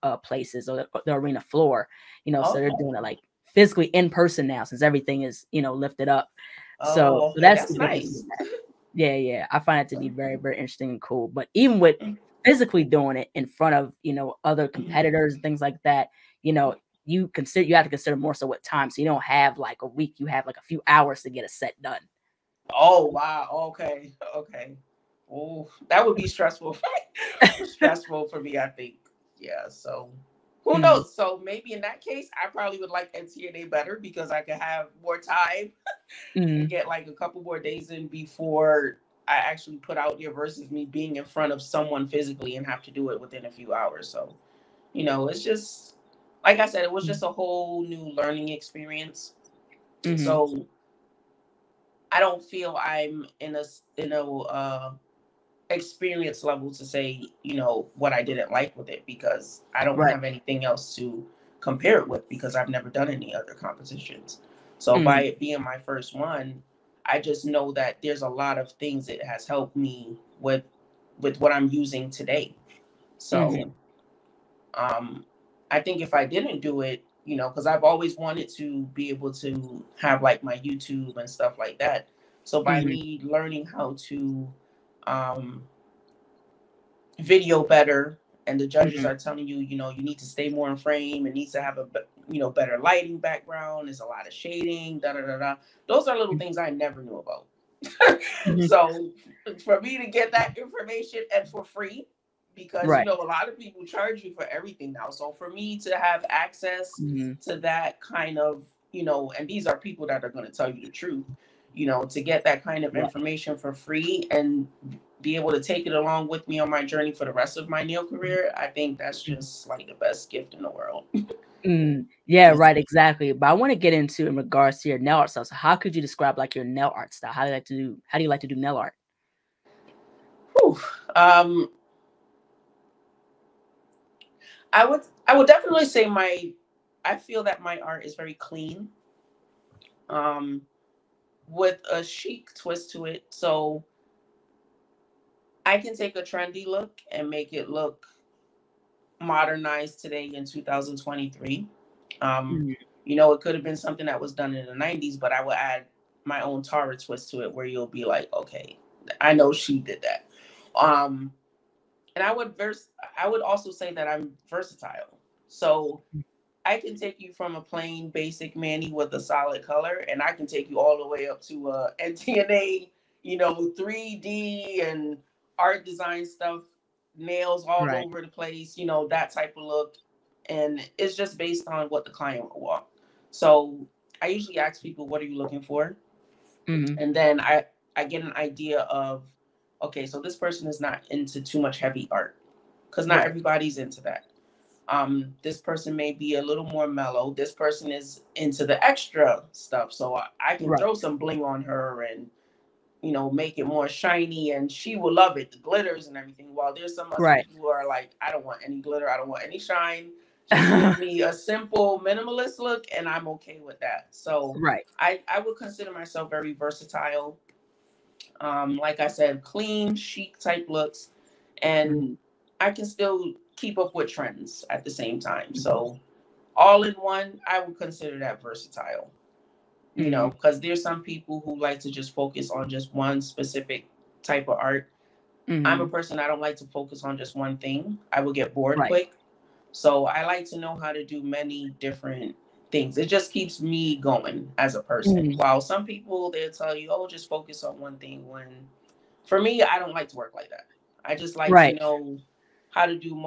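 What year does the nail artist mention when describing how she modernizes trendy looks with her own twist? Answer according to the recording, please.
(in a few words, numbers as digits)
2023.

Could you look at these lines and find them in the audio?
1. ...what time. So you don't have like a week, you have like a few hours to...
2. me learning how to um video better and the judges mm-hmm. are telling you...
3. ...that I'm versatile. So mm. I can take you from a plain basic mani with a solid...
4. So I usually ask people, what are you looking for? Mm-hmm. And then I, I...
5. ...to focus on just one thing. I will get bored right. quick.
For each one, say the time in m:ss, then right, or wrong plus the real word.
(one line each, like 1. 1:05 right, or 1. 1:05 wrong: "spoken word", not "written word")
1. 0:18 right
2. 1:22 right
3. 2:43 right
4. 3:03 right
5. 3:56 right.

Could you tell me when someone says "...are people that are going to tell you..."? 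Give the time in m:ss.
1:49.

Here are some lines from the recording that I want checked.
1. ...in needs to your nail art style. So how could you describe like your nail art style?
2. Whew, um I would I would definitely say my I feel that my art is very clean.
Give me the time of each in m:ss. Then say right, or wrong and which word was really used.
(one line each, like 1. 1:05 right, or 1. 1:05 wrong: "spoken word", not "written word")
1. 2:04 wrong: "regards", not "needs"
2. 2:10 right.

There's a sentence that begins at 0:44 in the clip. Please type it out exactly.
So, you know, it's just like I said, it was just a whole new learning experience.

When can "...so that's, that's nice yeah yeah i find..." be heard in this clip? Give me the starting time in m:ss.
0:07.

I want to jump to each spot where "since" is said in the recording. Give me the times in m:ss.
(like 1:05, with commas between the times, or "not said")
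0:04.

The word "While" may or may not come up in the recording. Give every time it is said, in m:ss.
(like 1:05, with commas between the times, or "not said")
3:26, 4:05.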